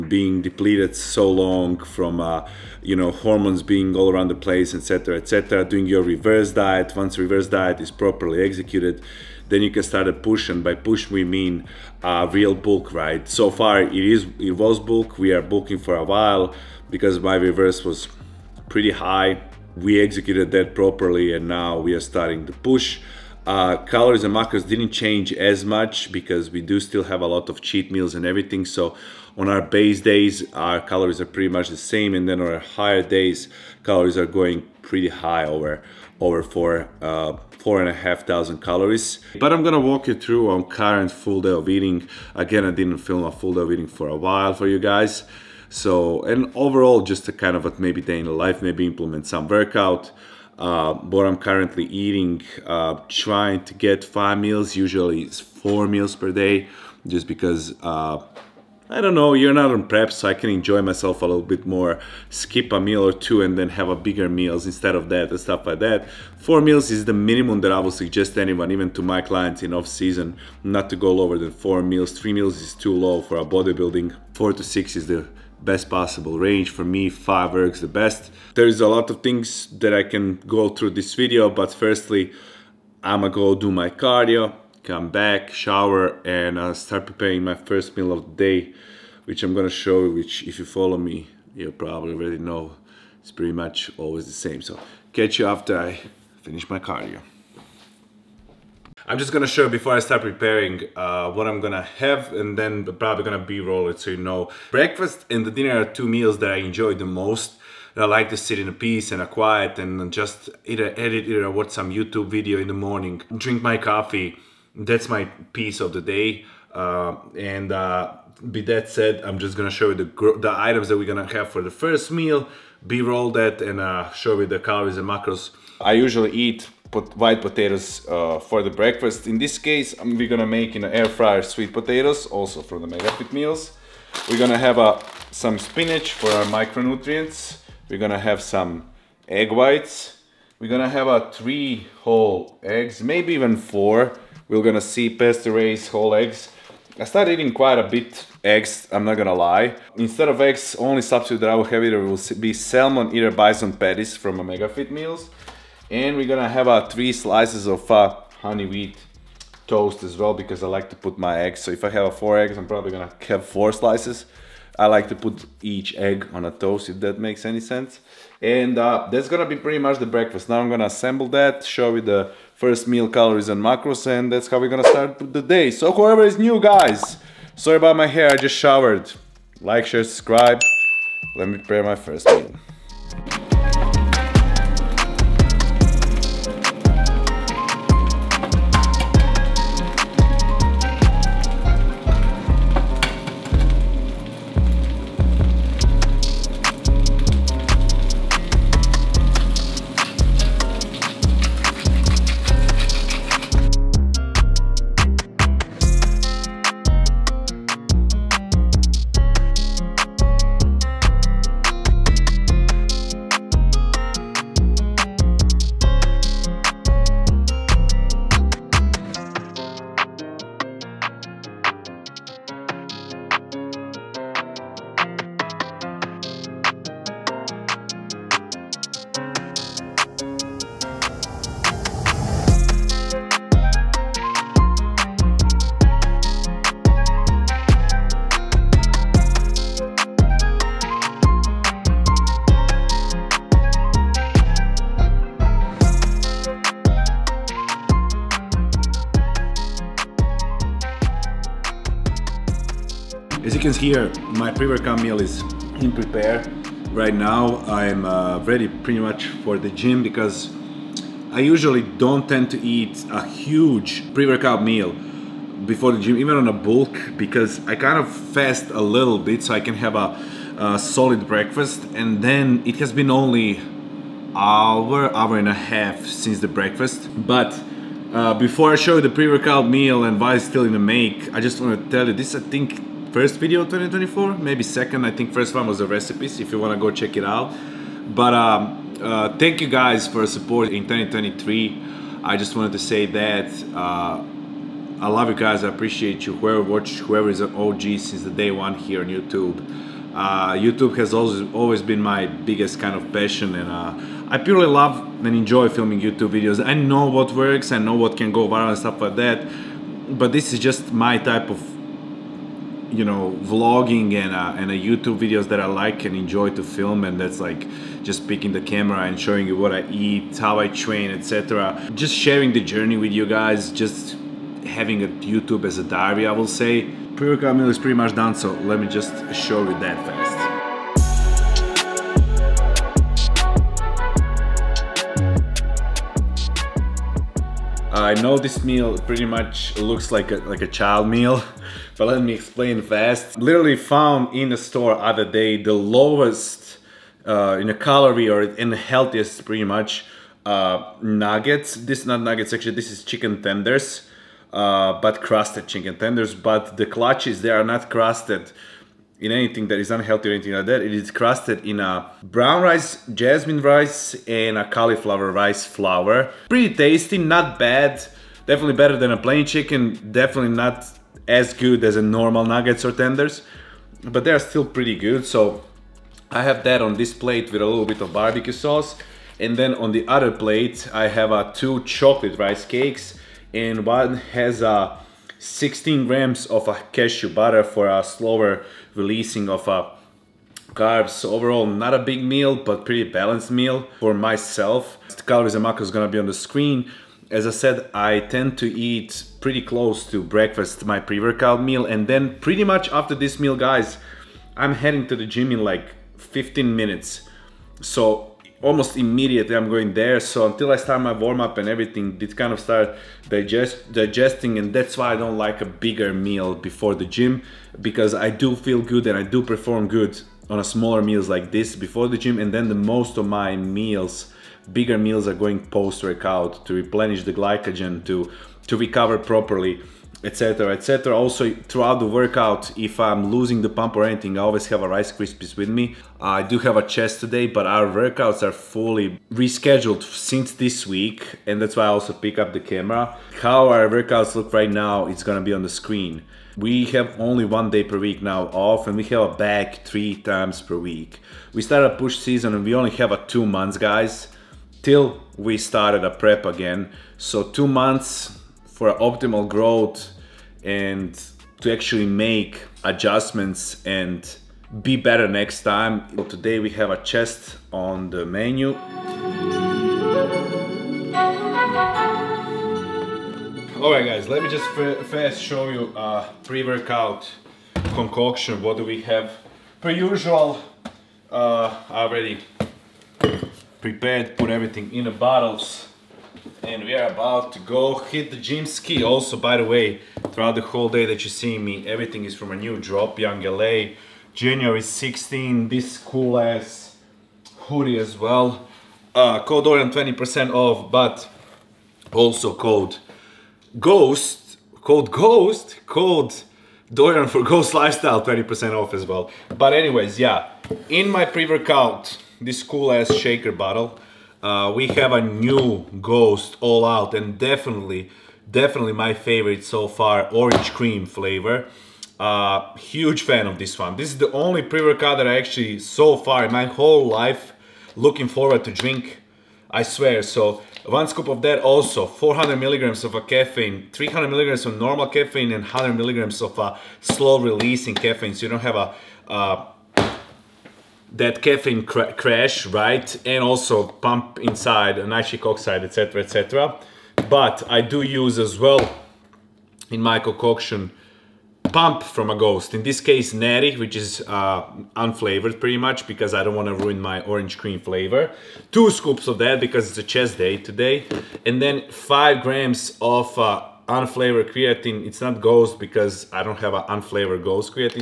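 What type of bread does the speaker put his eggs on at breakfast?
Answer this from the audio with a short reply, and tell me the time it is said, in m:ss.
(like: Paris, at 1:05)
honey wheat toast, at 2:38.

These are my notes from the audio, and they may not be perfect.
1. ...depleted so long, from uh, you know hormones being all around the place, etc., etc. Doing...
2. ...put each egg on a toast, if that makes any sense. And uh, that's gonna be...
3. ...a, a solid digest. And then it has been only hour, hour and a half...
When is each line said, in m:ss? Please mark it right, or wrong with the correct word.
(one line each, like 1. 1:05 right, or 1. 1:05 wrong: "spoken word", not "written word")
1. 0:00 right
2. 2:45 right
3. 4:29 wrong: "breakfast", not "digest".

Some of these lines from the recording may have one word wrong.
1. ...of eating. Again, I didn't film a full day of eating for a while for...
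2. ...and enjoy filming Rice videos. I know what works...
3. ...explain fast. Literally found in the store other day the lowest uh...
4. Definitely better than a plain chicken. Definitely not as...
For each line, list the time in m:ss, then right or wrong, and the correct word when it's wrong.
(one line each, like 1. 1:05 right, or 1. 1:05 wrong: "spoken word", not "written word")
1. 0:41 right
2. 5:05 wrong: "YouTube", not "Rice"
3. 5:42 right
4. 6:08 right.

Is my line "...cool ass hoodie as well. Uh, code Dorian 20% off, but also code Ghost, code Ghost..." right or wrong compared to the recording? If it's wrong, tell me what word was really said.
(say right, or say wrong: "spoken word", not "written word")
right.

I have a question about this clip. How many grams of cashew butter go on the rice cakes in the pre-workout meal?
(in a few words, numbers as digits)
16 grams.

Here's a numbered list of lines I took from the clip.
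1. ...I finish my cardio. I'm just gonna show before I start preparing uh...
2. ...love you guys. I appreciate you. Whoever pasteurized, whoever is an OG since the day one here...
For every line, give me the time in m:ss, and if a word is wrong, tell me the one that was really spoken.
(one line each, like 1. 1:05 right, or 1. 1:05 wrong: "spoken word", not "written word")
1. 1:35 right
2. 4:55 wrong: "watched", not "pasteurized".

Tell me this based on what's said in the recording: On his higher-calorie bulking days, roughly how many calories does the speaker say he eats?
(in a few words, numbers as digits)
4,500.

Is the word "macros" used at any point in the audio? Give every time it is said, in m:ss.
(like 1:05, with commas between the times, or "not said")
0:24, 2:05, 2:53, 6:35.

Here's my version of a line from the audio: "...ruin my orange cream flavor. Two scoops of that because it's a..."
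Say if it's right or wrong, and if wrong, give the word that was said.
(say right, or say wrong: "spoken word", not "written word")
right.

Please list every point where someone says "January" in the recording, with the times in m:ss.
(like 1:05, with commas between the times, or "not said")
8:14.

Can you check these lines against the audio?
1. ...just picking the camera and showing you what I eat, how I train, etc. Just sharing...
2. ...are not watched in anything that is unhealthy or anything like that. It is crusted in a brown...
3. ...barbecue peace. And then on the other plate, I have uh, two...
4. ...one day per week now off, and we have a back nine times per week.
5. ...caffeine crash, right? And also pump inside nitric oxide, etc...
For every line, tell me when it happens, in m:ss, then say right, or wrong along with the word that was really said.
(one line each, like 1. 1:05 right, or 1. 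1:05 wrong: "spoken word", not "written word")
1. 5:18 right
2. 5:57 wrong: "crusted", not "watched"
3. 6:18 wrong: "sauce", not "peace"
4. 7:27 wrong: "three", not "nine"
5. 9:01 right.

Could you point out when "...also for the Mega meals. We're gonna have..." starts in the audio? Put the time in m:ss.
2:12.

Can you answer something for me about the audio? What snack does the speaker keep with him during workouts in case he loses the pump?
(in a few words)
Rice Krispies.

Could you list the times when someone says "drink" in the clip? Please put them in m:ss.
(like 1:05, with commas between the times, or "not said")
1:53, 8:48.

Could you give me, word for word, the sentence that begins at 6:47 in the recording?
So almost immediately I'm going there.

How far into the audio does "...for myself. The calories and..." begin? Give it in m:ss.
6:33.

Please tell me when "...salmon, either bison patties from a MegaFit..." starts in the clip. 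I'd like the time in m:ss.
2:32.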